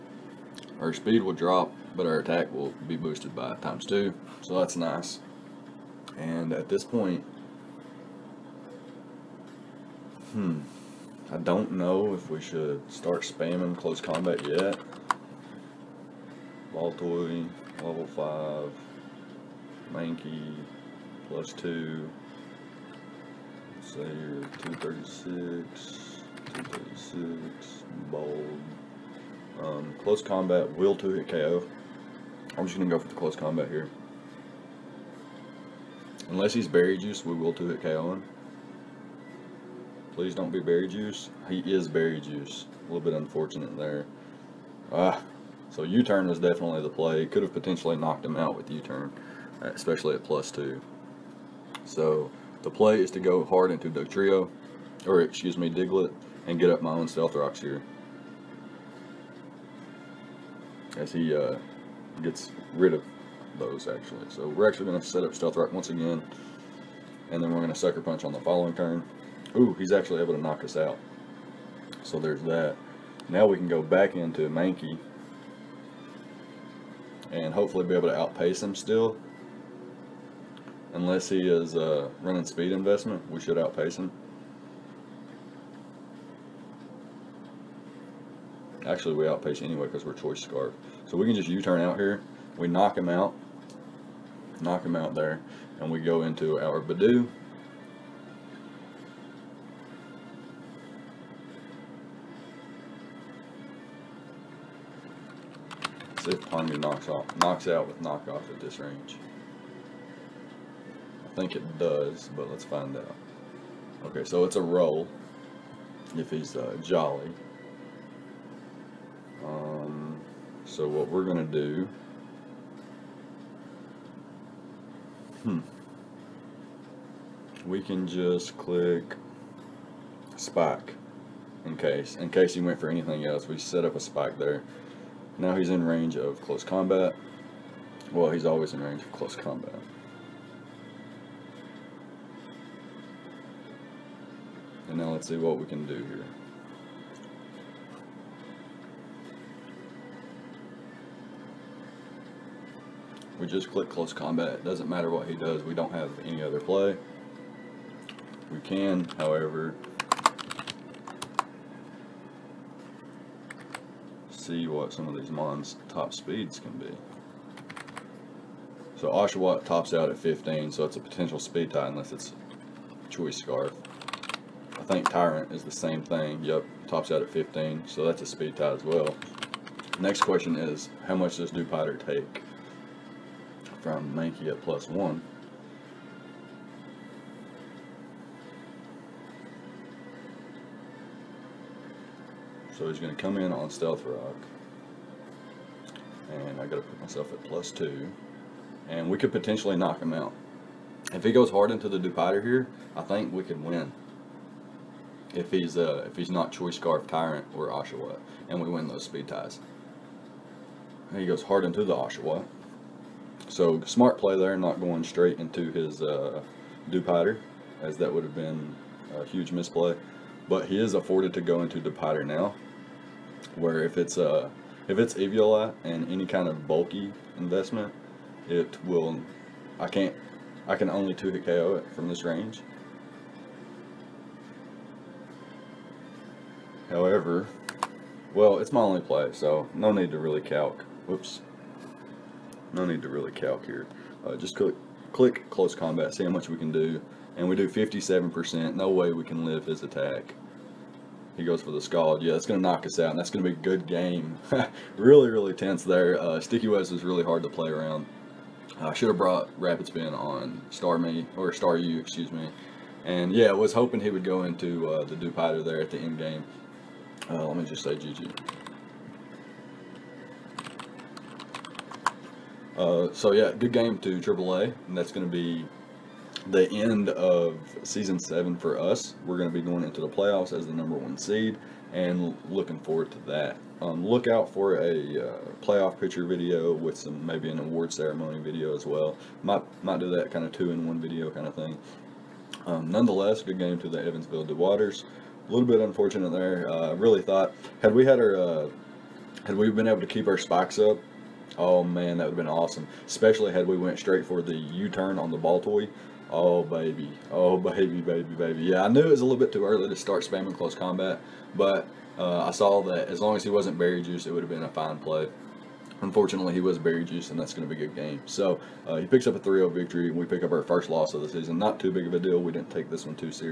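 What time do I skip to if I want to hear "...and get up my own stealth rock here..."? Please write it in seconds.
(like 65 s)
56 s.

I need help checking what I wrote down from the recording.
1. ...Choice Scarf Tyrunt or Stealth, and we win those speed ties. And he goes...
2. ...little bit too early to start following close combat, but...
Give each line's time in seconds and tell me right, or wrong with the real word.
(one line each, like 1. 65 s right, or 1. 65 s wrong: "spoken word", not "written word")
1. 206 s wrong: "Oshawott", not "Stealth"
2. 309 s wrong: "spamming", not "following".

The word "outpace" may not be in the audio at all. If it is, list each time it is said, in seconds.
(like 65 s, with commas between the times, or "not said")
78 s, 83 s, 89 s.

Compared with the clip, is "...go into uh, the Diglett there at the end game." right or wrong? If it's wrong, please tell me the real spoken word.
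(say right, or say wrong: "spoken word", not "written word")
wrong: "Dewpider", not "Diglett".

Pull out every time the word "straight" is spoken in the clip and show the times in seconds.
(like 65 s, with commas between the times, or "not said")
215 s, 303 s.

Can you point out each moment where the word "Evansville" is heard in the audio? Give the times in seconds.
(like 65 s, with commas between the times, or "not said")
294 s.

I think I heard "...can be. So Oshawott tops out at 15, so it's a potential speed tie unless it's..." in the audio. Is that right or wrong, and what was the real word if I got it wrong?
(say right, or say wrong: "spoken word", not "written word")
right.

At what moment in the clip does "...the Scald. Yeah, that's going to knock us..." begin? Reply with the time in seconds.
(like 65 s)
251 s.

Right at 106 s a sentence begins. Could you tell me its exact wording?
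See if Ponga knocks, off, knocks out with knockoff at this range.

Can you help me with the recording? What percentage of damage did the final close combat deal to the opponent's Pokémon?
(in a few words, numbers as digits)
57%.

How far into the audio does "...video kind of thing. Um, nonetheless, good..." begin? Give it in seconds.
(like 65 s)
290 s.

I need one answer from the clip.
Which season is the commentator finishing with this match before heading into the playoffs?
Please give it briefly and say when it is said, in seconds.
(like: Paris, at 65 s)
Season 7, at 277 s.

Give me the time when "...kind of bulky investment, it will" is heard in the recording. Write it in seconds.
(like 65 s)
226 s.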